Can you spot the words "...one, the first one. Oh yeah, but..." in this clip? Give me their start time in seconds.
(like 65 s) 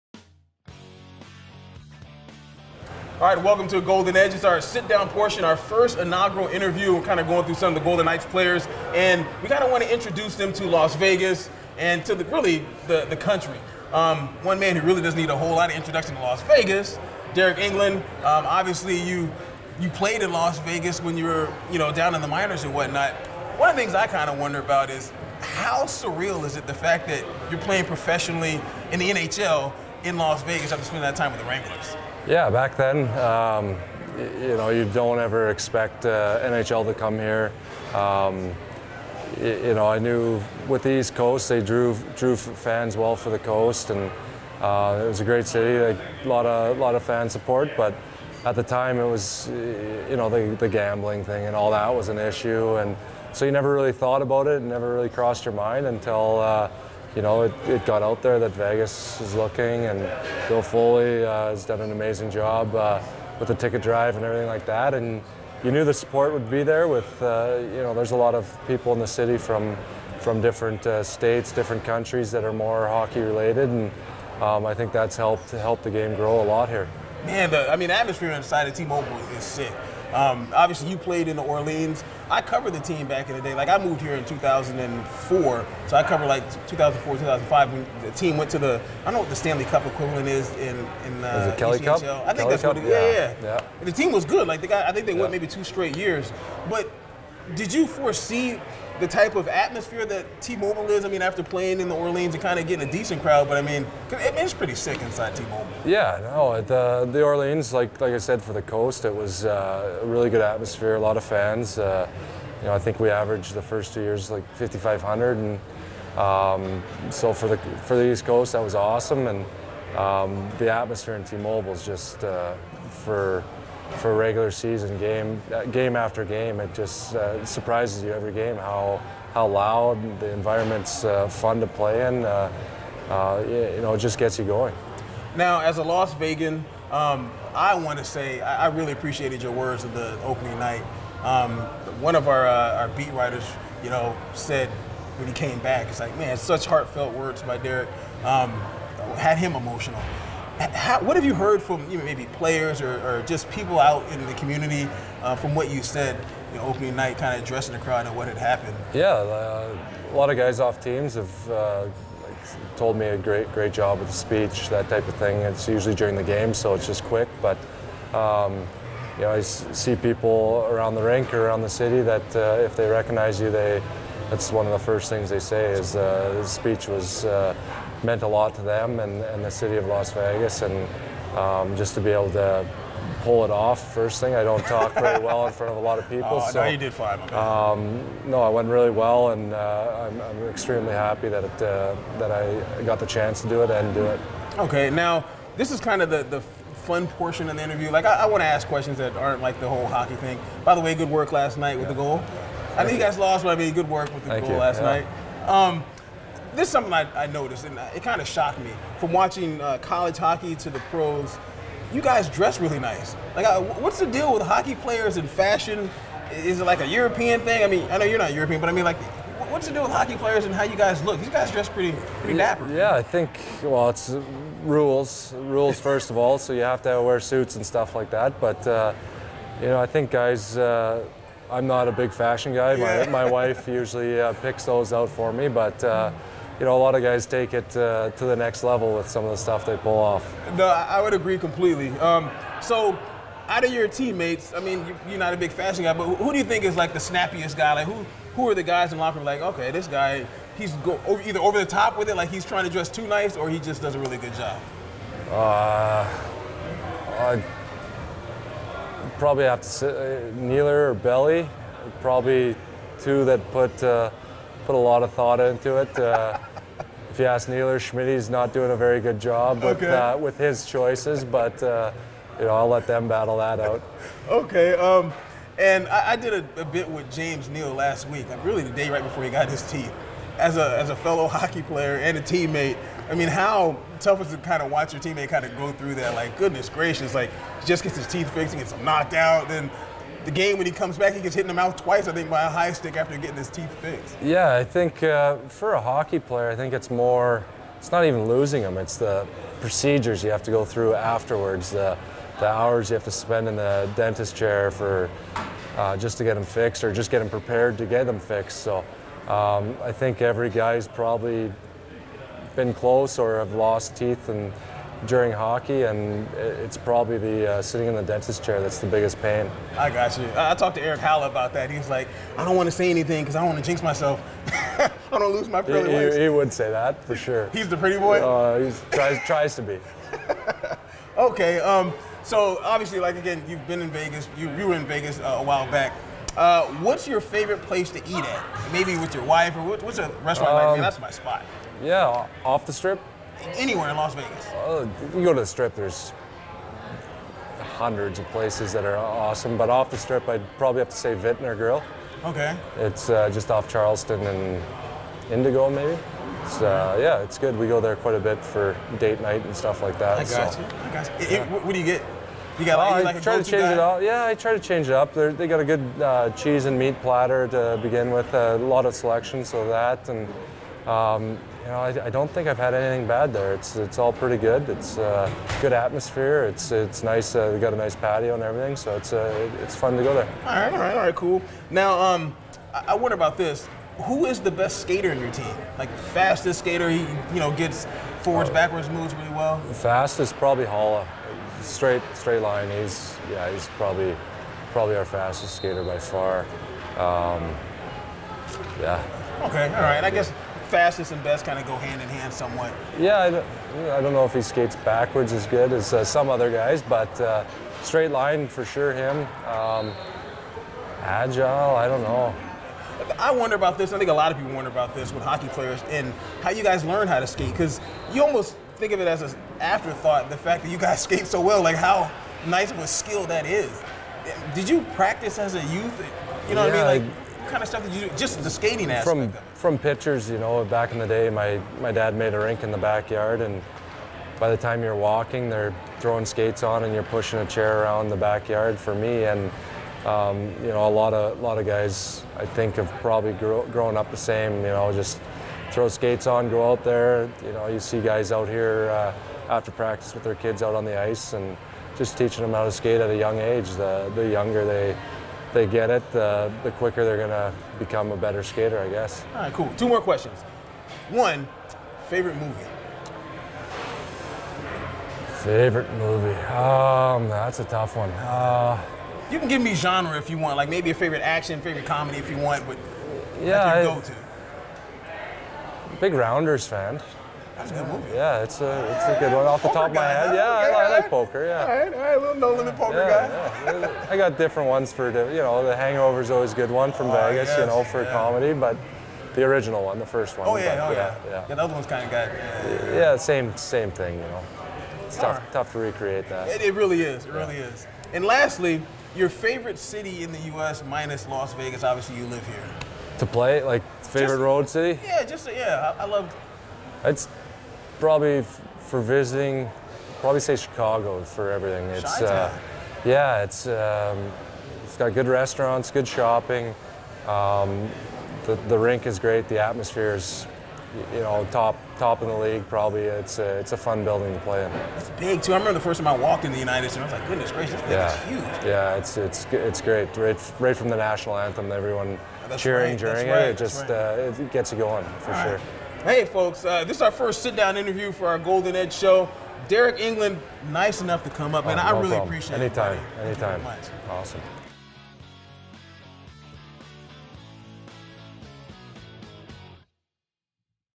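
489 s.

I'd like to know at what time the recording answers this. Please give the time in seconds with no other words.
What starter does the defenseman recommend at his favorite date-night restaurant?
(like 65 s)
366 s.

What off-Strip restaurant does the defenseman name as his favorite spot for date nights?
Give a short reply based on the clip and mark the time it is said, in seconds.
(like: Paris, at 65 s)
Vintner Grill, at 351 s.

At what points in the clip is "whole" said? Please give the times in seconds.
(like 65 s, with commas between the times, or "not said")
15 s, 199 s.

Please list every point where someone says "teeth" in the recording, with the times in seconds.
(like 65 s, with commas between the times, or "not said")
279 s, 288 s, 293 s, 313 s.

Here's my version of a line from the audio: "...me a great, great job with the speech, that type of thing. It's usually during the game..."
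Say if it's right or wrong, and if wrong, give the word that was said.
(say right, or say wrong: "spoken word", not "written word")
right.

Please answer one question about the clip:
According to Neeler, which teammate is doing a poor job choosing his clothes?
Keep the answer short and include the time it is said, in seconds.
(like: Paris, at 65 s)
Schmidty, at 267 s.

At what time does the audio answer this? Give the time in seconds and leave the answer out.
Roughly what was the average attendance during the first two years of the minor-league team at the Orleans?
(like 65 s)
114 s.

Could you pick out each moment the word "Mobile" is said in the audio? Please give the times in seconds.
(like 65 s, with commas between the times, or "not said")
78 s, 100 s, 105 s, 121 s.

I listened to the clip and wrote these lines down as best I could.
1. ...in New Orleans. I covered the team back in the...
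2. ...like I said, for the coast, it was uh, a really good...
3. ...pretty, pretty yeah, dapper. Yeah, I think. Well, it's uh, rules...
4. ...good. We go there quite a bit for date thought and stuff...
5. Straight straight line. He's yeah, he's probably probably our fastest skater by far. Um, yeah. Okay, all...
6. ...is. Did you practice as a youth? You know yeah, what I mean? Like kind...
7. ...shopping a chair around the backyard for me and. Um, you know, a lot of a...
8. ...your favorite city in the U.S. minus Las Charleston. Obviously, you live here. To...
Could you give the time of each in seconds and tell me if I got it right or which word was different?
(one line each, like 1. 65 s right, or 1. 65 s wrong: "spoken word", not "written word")
1. 81 s right
2. 107 s right
3. 221 s right
4. 357 s wrong: "night", not "thought"
5. 391 s right
6. 423 s right
7. 437 s wrong: "pushing", not "shopping"
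8. 499 s wrong: "Vegas", not "Charleston".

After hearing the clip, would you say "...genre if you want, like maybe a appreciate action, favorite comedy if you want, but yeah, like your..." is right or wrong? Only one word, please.
wrong.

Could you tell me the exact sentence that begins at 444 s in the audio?
You know, just throw skates on, go out there.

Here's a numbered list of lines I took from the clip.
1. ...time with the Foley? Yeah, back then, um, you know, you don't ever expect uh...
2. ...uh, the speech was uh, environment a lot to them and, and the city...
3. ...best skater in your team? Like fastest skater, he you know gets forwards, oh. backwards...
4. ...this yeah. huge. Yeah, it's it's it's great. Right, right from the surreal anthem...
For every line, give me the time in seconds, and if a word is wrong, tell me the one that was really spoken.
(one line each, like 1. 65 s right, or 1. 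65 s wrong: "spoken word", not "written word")
1. 31 s wrong: "Wranglers", not "Foley"
2. 175 s wrong: "meant", not "environment"
3. 384 s right
4. 527 s wrong: "national", not "surreal".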